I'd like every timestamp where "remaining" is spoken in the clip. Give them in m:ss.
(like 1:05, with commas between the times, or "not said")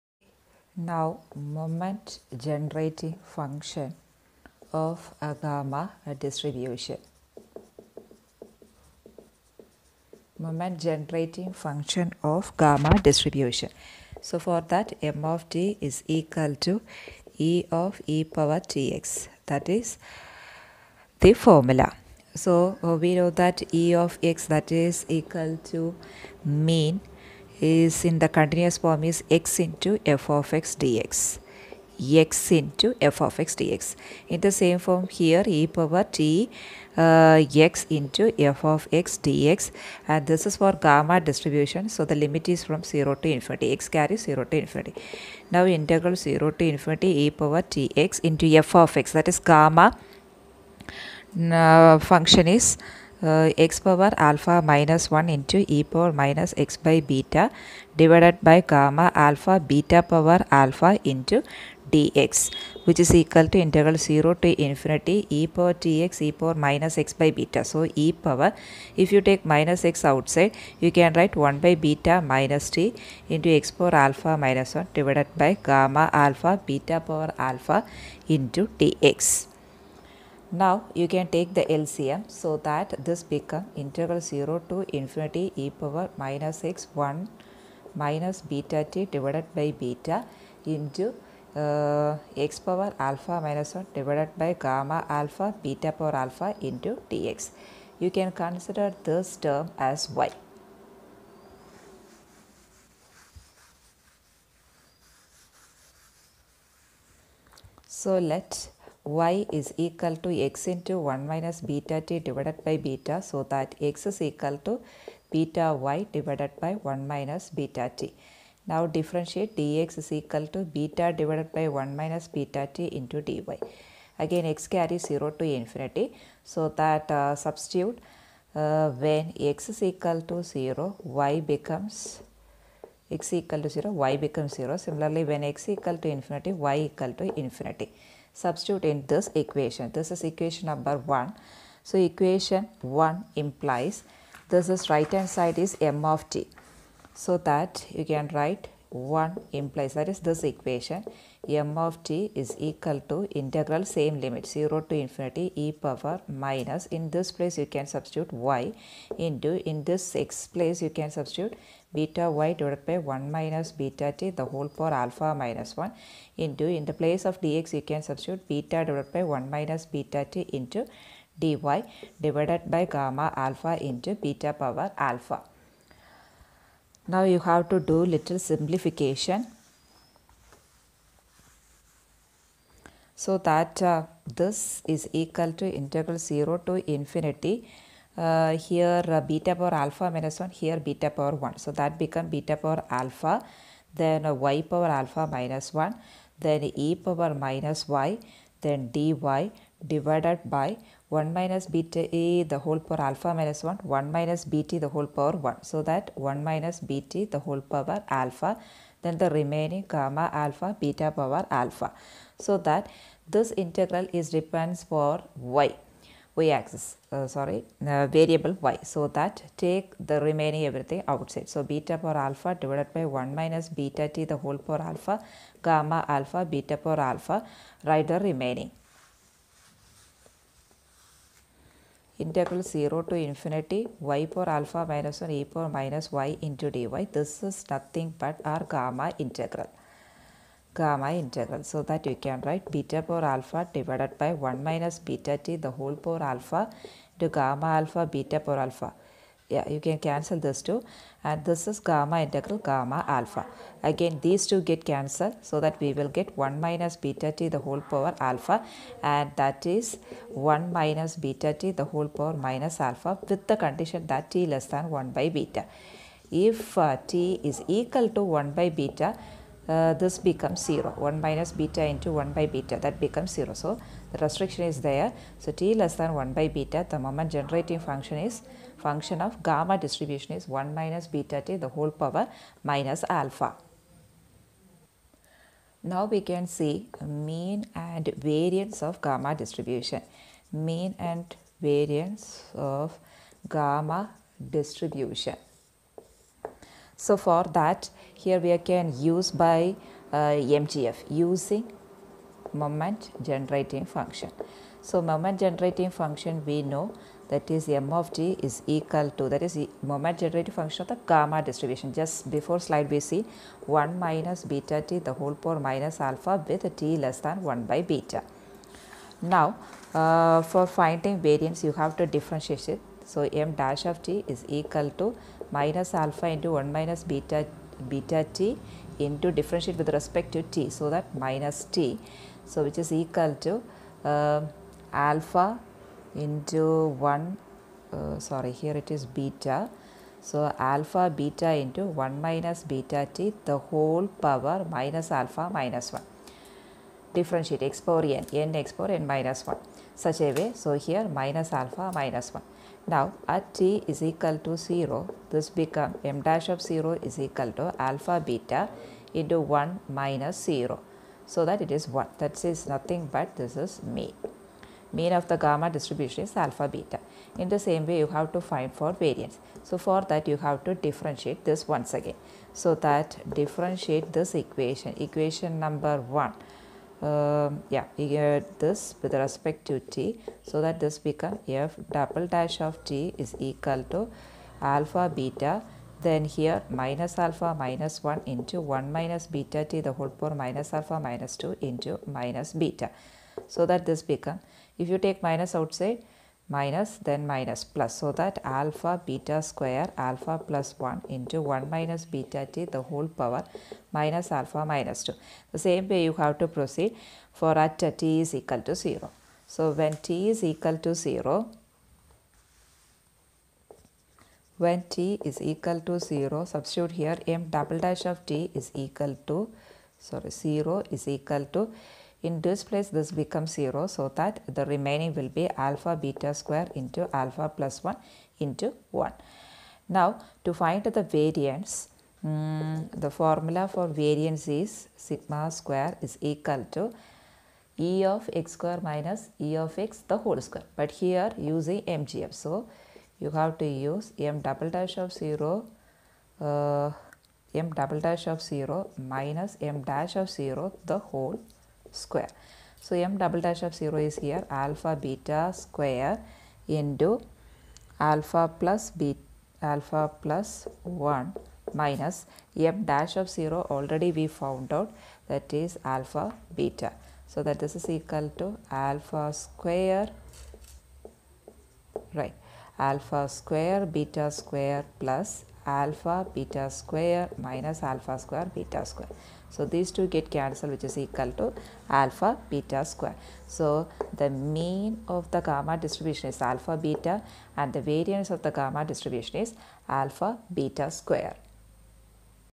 3:29, 3:40, 3:48, 7:04.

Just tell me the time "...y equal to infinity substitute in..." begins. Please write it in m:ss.
2:16.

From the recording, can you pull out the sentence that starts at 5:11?
Just before slide we see 1 minus beta t the whole power minus alpha with t less than 1 by beta.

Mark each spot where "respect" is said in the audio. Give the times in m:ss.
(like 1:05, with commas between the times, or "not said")
5:29, 6:19.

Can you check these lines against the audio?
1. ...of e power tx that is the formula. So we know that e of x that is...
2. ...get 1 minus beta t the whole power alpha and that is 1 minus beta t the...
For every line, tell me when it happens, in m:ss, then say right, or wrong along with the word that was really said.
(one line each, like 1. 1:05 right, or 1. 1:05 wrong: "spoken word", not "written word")
1. 0:17 right
2. 4:16 right.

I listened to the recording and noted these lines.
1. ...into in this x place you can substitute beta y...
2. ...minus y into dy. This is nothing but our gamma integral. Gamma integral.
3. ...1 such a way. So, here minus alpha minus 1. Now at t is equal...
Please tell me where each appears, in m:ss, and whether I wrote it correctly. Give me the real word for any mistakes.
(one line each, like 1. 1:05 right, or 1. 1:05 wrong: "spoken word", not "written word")
1. 2:39 right
2. 3:55 right
3. 5:49 right.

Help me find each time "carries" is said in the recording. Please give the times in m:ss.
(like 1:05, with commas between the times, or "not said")
0:43, 2:04.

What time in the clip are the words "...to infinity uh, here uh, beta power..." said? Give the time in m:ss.
3:06.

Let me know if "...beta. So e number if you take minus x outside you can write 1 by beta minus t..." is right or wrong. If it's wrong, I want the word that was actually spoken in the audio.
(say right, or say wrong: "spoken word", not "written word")
wrong: "power", not "number".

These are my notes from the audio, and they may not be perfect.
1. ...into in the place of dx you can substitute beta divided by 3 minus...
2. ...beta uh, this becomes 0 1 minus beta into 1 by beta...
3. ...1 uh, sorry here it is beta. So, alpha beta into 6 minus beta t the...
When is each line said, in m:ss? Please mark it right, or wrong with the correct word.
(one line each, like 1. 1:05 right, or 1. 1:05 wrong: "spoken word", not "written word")
1. 2:46 wrong: "1", not "3"
2. 4:28 right
3. 5:37 wrong: "1", not "6".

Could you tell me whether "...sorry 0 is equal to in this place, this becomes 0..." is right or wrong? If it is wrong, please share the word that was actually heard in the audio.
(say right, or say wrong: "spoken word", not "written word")
right.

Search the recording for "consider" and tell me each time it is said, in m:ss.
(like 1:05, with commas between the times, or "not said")
1:38.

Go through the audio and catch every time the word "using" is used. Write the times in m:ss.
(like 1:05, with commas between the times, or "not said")
5:01, 7:21.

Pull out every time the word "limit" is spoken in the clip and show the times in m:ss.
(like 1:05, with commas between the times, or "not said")
0:42, 2:34.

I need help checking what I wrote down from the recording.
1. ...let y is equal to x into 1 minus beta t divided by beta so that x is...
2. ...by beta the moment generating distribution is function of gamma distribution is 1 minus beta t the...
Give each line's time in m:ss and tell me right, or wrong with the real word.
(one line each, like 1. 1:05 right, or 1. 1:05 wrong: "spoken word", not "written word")
1. 1:48 right
2. 4:36 wrong: "function", not "distribution".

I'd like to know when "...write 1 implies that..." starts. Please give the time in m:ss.
2:28.